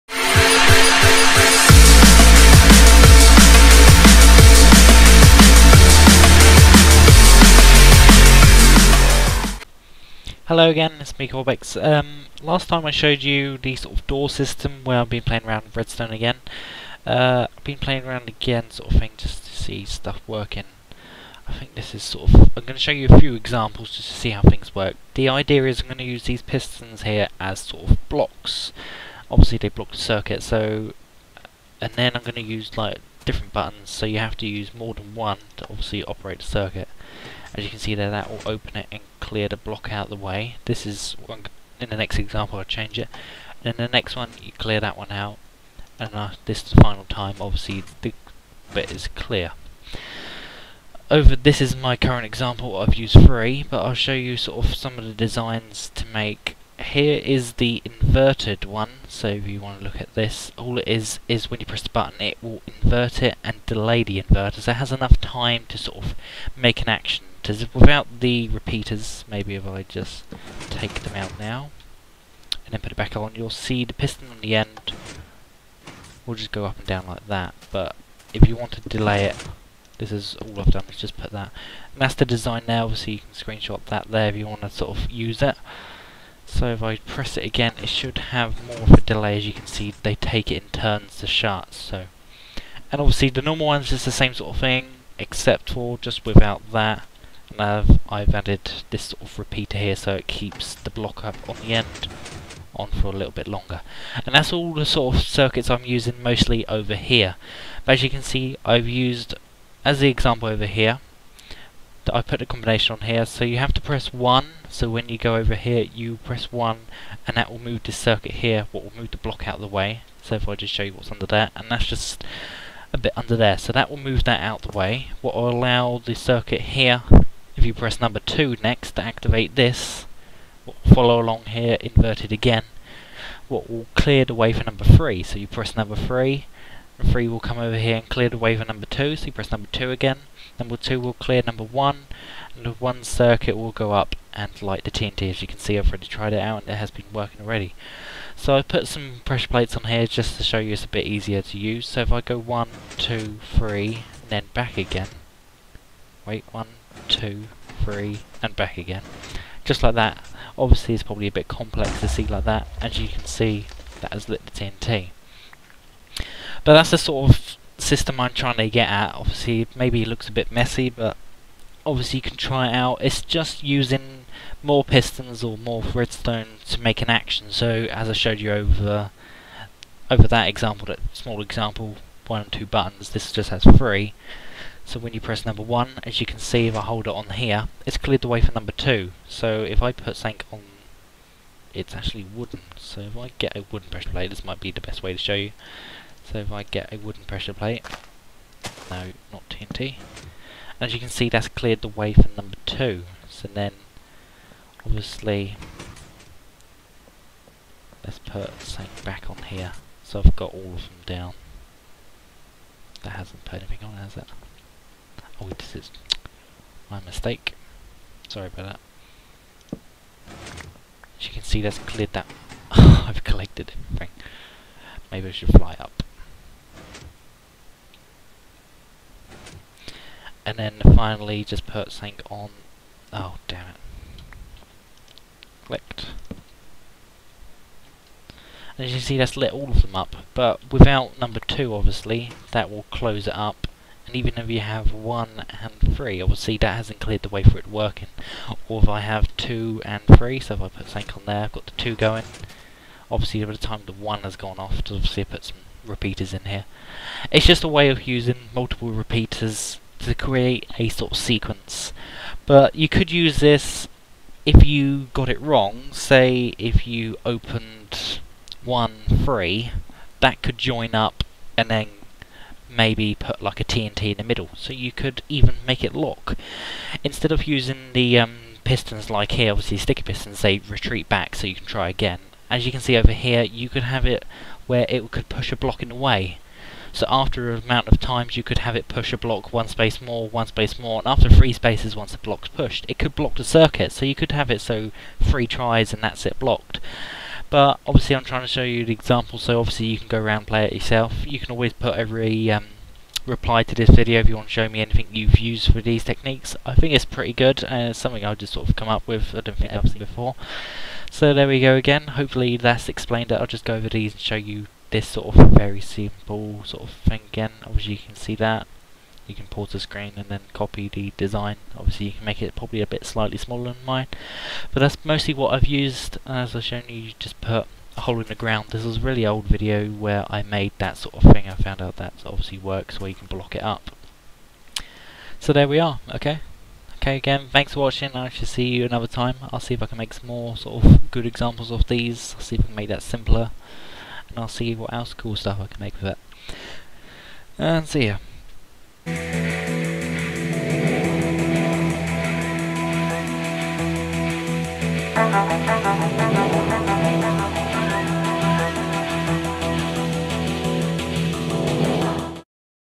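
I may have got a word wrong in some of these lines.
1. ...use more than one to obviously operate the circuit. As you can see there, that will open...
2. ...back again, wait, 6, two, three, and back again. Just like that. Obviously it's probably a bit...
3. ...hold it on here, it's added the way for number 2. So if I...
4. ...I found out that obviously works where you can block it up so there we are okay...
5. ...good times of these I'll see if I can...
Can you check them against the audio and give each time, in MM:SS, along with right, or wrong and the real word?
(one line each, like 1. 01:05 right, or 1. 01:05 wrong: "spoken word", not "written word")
1. 00:34 right
2. 02:34 wrong: "1", not "6"
3. 03:06 wrong: "cleared", not "added"
4. 05:31 right
5. 05:41 wrong: "examples", not "times".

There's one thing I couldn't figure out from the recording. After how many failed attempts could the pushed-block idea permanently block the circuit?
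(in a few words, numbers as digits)
Three tries.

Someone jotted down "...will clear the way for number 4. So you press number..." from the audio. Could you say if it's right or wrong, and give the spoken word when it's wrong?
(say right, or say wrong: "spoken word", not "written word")
wrong: "3", not "4".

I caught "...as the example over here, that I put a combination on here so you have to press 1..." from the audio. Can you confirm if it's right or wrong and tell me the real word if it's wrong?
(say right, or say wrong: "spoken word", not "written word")
right.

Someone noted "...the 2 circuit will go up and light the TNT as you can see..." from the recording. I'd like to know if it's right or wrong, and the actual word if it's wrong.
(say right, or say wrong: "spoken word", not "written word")
wrong: "1", not "2".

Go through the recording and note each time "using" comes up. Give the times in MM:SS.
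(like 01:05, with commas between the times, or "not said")
01:45, 02:53, 04:18, 04:37.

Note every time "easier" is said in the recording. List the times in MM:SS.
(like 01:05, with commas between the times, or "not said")
02:31.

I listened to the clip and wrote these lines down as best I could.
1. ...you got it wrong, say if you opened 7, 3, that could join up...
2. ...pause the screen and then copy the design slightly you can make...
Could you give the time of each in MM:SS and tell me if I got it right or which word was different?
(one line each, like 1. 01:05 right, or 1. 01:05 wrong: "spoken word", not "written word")
1. 04:24 wrong: "1", not "7"
2. 05:19 wrong: "obviously", not "slightly".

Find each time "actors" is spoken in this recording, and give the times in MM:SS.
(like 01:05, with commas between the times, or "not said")
not said.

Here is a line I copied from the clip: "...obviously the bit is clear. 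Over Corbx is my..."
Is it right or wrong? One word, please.
wrong.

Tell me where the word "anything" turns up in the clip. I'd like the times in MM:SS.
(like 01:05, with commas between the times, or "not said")
03:33, 05:04.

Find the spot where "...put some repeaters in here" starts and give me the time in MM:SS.
04:15.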